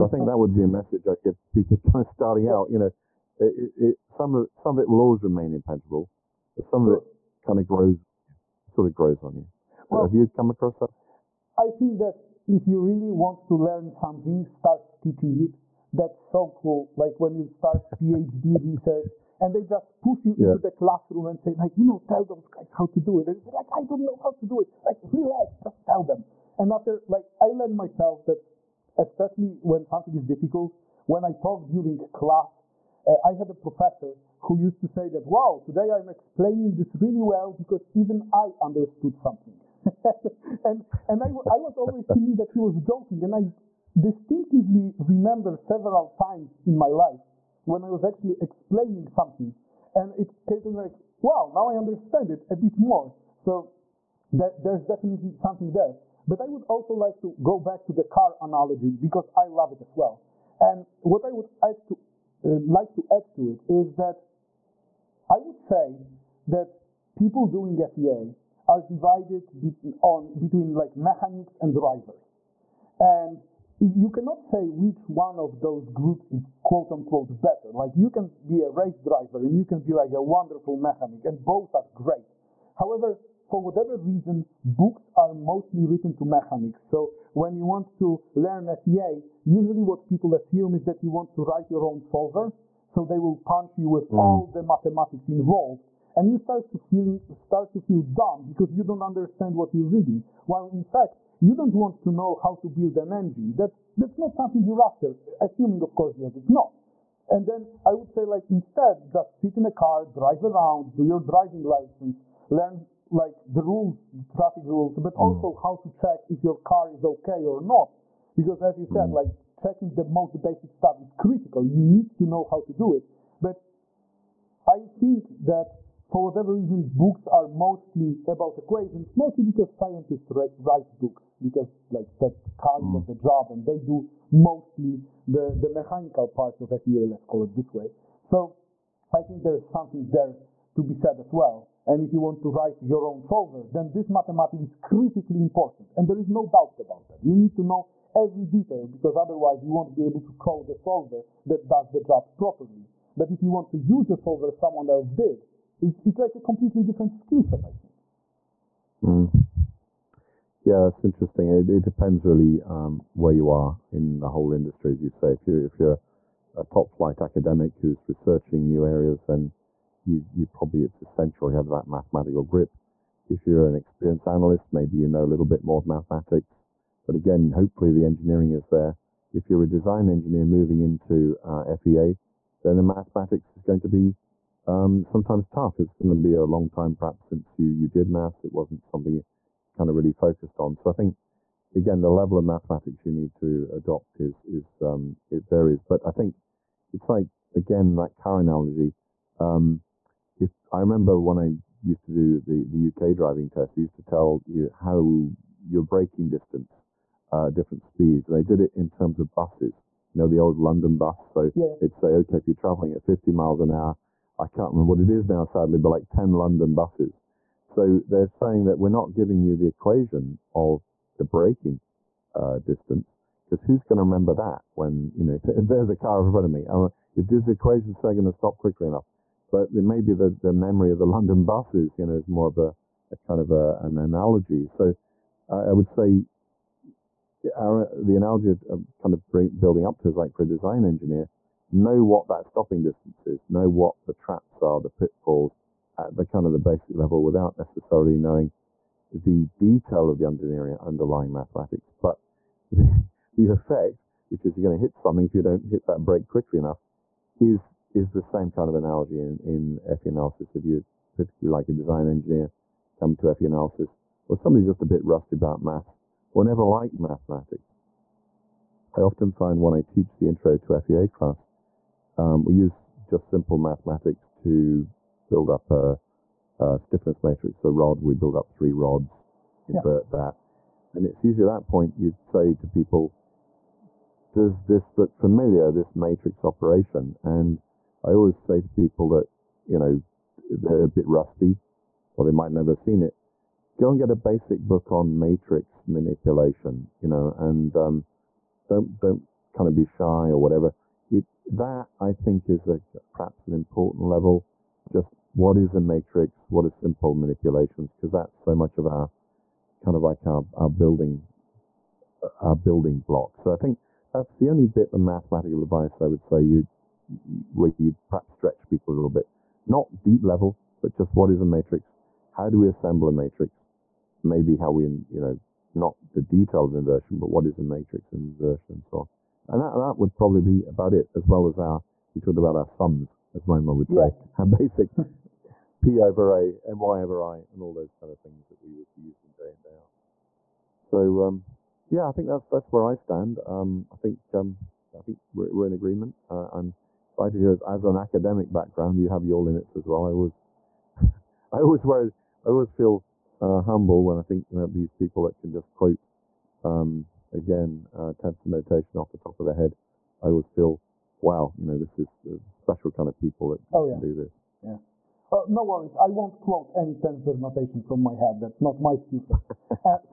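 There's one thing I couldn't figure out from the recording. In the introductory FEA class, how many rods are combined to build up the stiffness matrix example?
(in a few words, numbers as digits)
3.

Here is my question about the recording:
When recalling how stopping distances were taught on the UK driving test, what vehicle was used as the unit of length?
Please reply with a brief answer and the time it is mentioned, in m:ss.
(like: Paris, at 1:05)
London bus, at 3:30.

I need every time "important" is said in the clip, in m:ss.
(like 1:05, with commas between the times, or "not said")
2:25, 5:03.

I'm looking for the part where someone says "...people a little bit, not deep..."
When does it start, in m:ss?
5:18.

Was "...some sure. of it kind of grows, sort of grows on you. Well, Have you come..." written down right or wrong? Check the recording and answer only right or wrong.
right.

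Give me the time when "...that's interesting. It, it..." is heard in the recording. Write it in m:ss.
2:40.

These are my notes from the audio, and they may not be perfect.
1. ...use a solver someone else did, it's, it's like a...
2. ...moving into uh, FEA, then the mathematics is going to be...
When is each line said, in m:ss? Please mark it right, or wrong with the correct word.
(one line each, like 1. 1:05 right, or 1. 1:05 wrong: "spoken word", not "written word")
1. 2:33 right
2. 3:00 right.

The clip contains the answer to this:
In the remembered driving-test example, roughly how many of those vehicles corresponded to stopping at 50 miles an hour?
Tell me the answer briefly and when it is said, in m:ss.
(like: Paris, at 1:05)
10, at 3:36.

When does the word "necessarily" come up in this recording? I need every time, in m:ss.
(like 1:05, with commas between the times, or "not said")
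4:07.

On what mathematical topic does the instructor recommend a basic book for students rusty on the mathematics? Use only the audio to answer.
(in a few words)
Matrix manipulation.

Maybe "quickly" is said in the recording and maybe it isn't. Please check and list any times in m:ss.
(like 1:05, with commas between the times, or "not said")
3:48, 4:16.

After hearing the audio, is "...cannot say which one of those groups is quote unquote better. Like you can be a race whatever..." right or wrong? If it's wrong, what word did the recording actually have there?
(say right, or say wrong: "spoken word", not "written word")
wrong: "driver", not "whatever".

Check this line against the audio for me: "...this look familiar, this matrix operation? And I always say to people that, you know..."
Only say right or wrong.
right.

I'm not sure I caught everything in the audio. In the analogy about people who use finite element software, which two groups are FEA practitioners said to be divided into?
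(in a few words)
Mechanics and drivers.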